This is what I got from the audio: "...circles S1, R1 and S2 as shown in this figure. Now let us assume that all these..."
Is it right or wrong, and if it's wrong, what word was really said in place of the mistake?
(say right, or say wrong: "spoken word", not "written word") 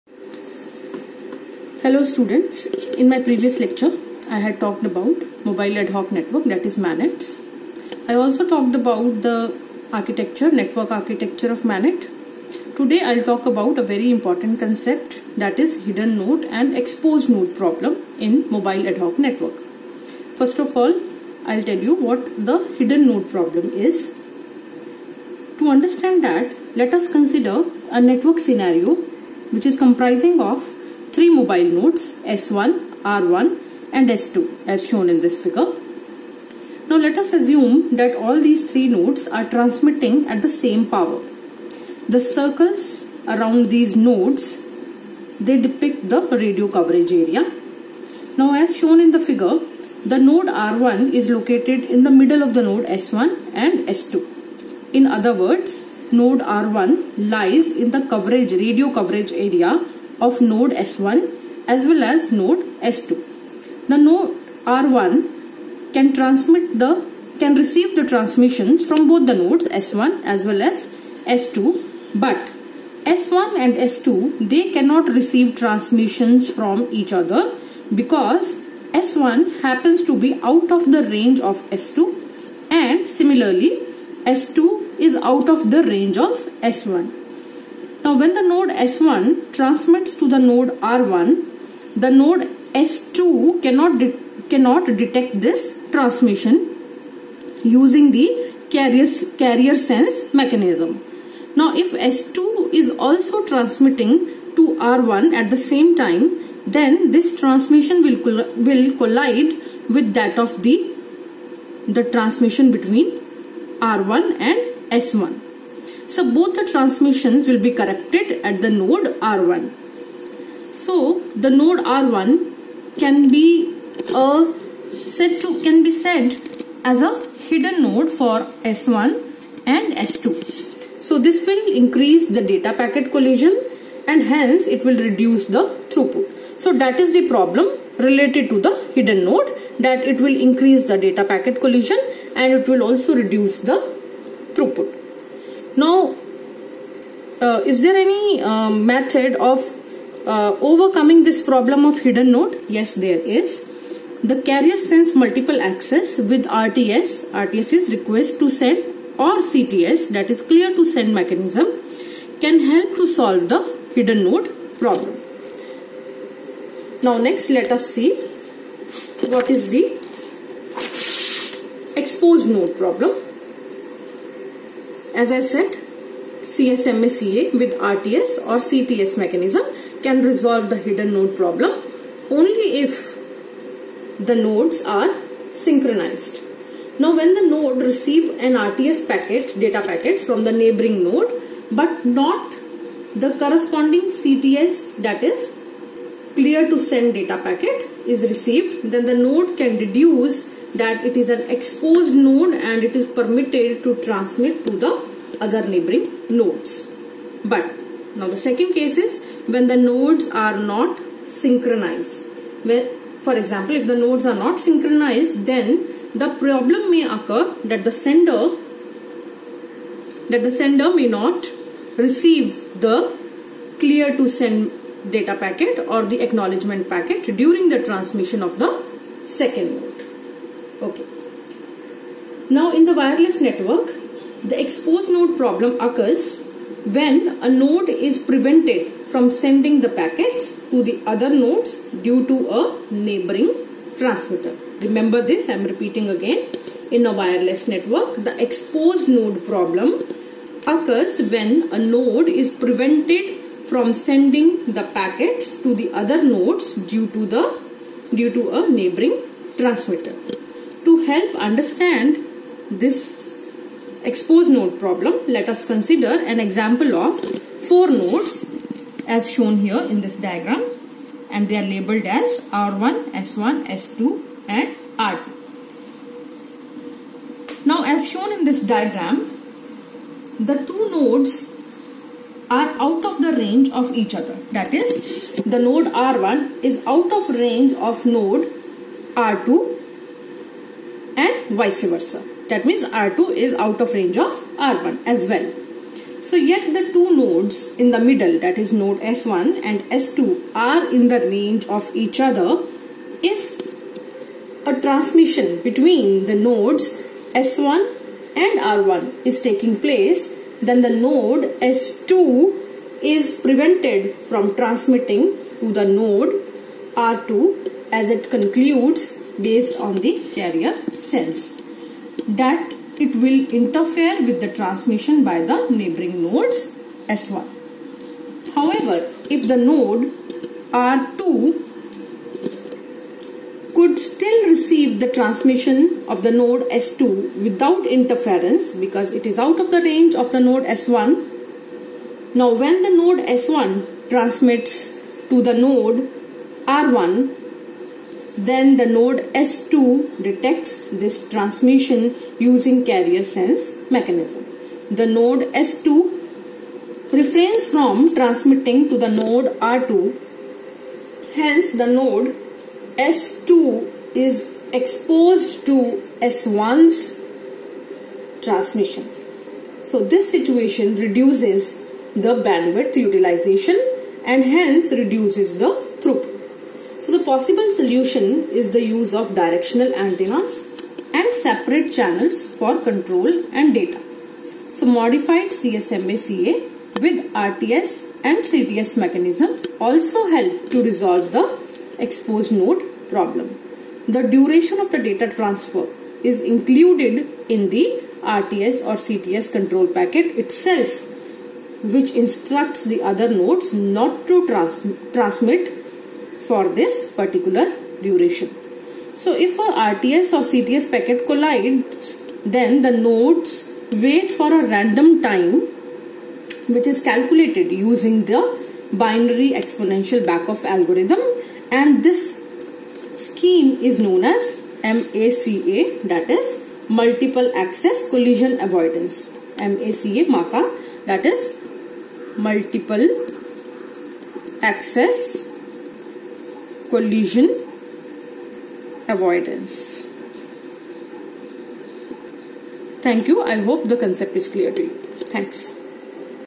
wrong: "nodes", not "circles".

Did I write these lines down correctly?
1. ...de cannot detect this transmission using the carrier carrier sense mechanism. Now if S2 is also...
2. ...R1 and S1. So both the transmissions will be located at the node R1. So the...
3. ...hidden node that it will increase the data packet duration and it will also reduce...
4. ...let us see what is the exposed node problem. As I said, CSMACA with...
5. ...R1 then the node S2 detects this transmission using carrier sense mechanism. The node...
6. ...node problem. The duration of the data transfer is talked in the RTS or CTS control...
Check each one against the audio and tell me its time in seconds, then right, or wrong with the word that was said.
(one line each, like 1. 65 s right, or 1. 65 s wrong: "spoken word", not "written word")
1. 93 s right
2. 113 s wrong: "corrected", not "located"
3. 138 s wrong: "collision", not "duration"
4. 167 s right
5. 346 s right
6. 392 s wrong: "included", not "talked".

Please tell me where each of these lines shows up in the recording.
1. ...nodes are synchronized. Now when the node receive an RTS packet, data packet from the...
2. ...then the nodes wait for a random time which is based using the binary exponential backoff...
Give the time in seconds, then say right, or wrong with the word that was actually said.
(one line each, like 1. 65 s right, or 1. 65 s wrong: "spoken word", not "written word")
1. 184 s right
2. 412 s wrong: "calculated", not "based".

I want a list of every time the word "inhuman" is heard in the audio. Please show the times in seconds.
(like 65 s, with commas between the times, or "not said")
not said.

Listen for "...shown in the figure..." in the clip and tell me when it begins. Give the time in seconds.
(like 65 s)
48 s.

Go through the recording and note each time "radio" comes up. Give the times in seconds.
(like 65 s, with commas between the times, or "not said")
46 s, 58 s.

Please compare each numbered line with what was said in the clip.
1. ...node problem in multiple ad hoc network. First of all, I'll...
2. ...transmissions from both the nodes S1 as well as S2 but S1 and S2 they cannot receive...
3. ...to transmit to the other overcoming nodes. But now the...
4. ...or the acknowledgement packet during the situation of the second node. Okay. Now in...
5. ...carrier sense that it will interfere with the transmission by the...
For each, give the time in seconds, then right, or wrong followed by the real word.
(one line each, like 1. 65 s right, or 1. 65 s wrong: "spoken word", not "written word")
1. 17 s wrong: "mobile", not "multiple"
2. 68 s right
3. 203 s wrong: "neighboring", not "overcoming"
4. 225 s wrong: "transmission", not "situation"
5. 320 s right.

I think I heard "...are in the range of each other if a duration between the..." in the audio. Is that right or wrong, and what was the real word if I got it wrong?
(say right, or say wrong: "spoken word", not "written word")
wrong: "transmission", not "duration".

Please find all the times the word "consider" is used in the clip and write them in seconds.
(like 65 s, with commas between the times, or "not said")
27 s, 265 s.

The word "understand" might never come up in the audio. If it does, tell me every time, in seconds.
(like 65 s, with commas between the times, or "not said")
25 s, 261 s.